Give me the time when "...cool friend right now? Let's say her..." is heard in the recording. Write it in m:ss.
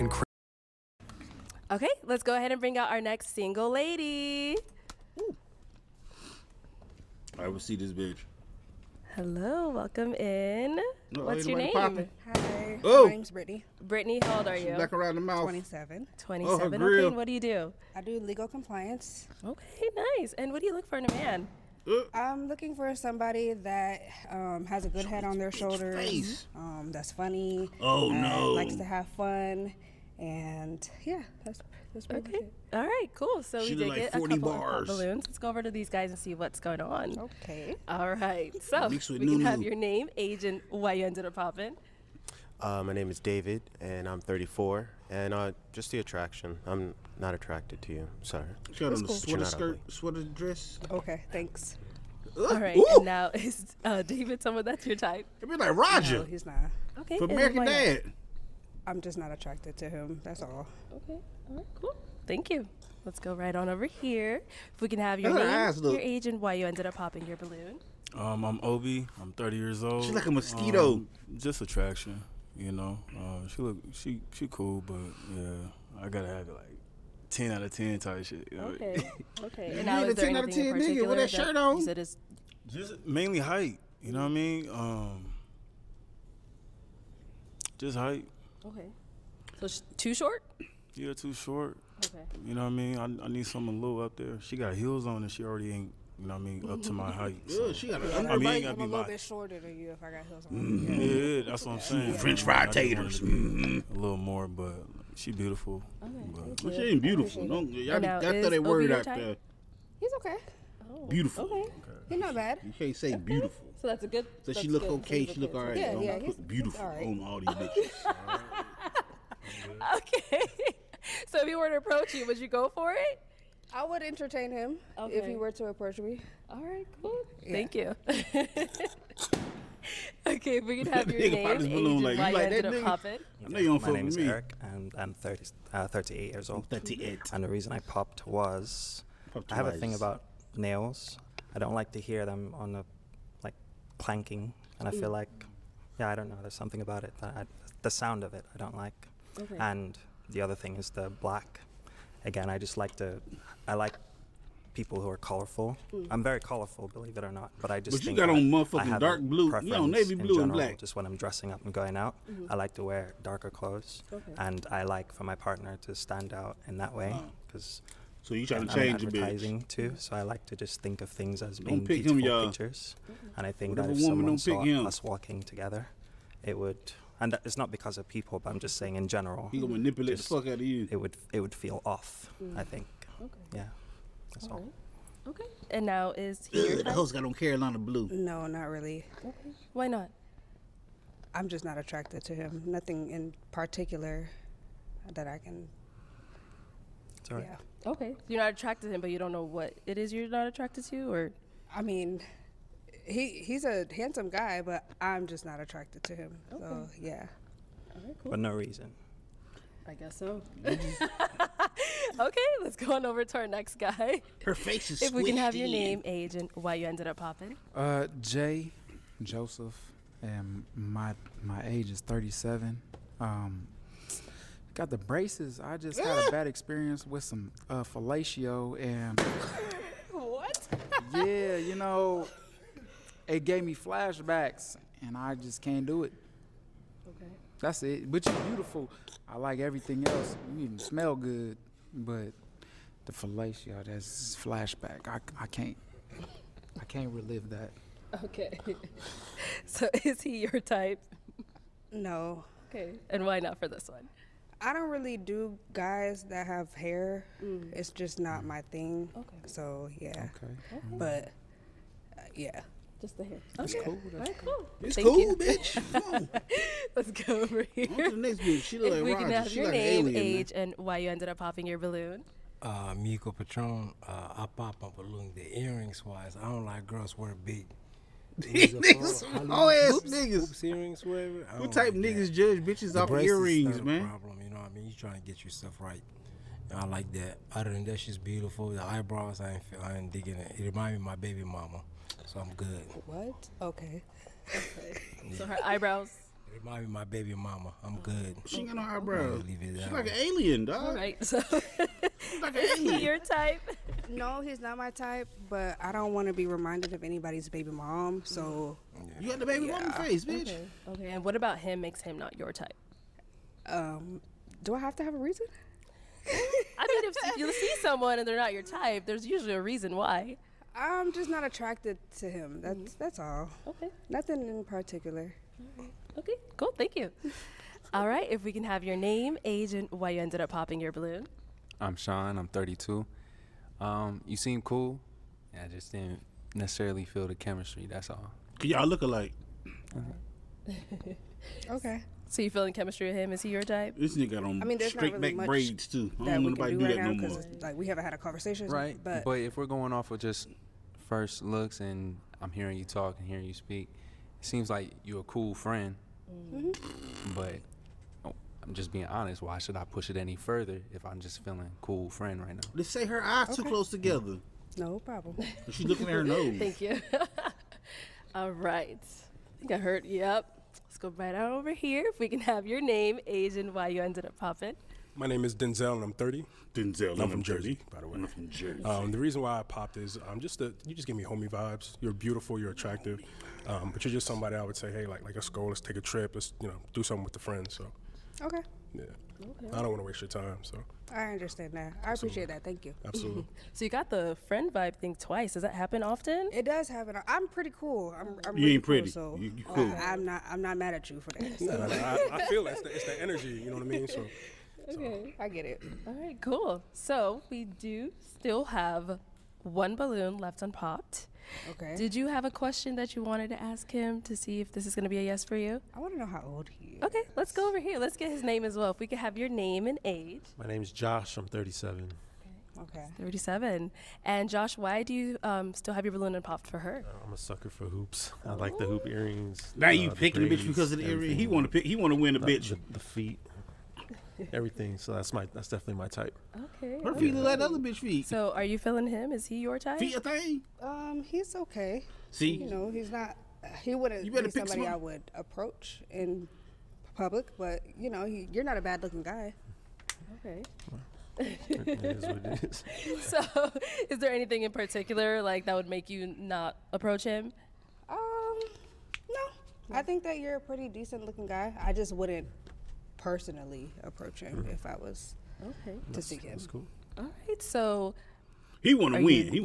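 6:01.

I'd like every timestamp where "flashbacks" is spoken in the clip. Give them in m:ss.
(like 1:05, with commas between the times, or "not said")
3:53, 4:04.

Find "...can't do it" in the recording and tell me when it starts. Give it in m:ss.
3:55.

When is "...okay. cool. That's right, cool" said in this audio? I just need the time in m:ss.
4:23.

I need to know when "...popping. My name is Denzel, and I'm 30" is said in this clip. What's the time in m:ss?
6:14.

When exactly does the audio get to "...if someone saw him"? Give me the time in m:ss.
2:53.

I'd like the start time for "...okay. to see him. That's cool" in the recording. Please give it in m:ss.
7:45.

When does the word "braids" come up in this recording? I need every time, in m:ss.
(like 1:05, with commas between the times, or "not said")
5:45.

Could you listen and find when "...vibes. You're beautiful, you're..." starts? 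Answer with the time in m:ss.
6:21.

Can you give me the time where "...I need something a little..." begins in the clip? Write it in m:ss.
1:33.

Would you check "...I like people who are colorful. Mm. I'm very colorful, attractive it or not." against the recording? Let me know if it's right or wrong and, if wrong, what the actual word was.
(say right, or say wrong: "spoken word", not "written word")
wrong: "believe", not "attractive".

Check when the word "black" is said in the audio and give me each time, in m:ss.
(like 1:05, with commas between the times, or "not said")
2:31, 2:40.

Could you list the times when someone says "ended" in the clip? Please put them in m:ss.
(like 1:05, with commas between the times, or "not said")
0:41, 1:06, 3:36, 4:31, 5:30, 6:14.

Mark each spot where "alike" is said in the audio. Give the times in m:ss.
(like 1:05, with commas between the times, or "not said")
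5:39.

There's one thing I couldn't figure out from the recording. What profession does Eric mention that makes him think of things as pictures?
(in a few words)
Advertising.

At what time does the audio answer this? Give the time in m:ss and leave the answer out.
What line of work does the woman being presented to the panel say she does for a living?
0:18.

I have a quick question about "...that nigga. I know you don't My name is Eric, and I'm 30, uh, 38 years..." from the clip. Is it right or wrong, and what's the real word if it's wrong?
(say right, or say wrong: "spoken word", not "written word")
right.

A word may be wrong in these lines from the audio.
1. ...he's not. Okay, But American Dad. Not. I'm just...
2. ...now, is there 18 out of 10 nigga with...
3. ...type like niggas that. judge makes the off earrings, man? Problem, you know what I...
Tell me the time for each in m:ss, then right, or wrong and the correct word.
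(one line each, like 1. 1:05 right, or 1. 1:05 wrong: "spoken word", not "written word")
1. 0:56 right
2. 1:19 wrong: "10", not "18"
3. 4:41 wrong: "bitches", not "makes".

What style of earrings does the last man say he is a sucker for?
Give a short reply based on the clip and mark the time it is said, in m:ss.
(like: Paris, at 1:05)
Hoops, at 7:07.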